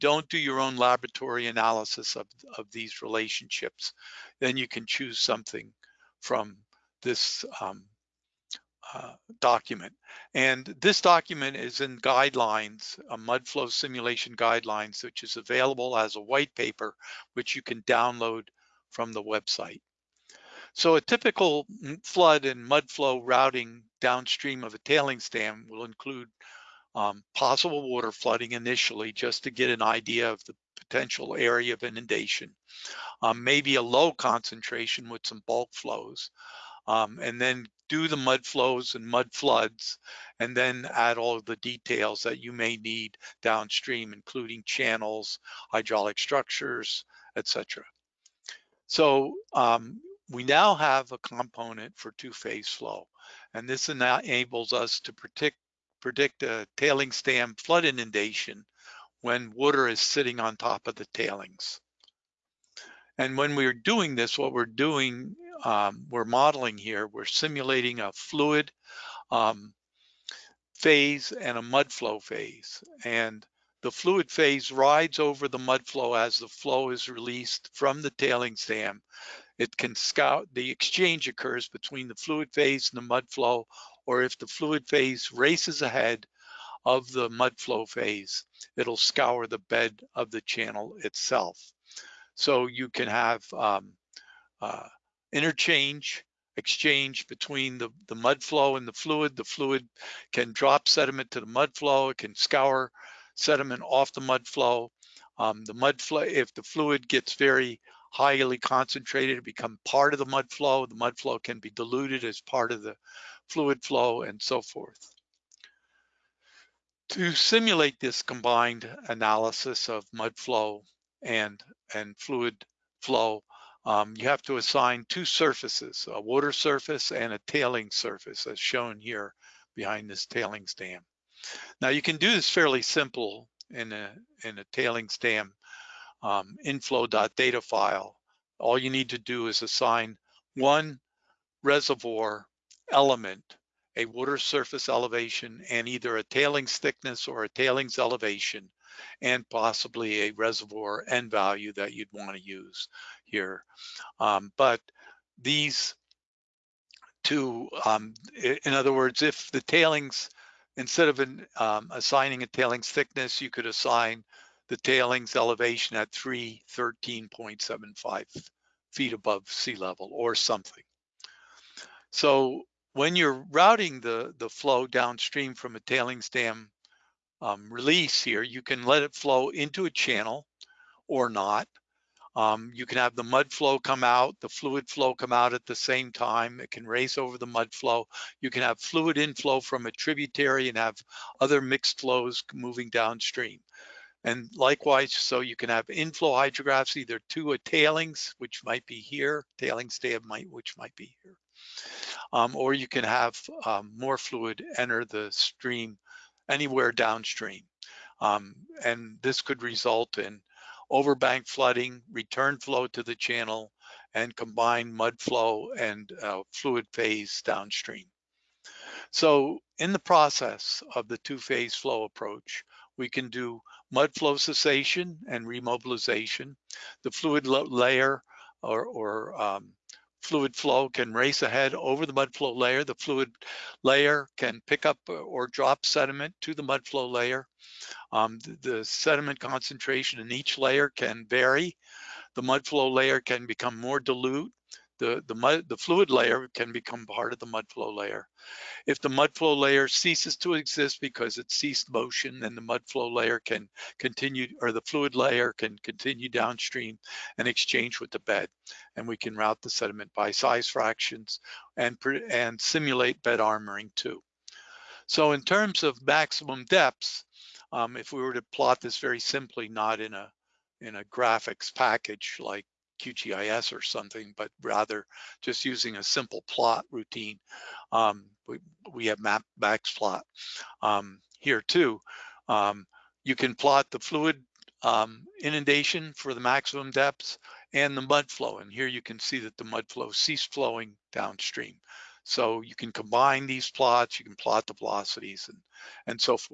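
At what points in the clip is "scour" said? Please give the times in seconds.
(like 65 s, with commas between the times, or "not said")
79 s, 88 s, 102 s.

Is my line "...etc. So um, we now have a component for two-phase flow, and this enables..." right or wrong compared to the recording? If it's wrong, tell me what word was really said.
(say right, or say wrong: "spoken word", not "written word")
right.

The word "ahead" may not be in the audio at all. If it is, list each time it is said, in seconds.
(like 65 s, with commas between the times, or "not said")
85 s, 231 s.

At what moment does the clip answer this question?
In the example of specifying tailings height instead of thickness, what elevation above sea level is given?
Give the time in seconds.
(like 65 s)
166 s.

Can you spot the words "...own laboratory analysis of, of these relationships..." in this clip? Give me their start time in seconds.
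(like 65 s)
0 s.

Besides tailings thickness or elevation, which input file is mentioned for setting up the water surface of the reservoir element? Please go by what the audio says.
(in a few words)
inflow.data.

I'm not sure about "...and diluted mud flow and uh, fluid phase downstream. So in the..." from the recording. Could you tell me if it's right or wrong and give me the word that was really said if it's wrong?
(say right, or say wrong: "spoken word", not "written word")
wrong: "combined", not "diluted".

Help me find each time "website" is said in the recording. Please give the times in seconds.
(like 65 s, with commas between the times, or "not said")
19 s.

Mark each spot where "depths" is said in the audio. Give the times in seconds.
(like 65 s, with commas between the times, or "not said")
266 s, 286 s.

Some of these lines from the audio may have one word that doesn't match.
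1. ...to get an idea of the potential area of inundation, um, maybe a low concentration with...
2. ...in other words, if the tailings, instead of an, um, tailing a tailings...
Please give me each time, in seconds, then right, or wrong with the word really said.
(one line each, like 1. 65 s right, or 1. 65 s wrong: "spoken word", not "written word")
1. 29 s right
2. 158 s wrong: "assigning", not "tailing".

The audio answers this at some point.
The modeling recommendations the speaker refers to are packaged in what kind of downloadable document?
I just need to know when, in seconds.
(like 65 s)
16 s.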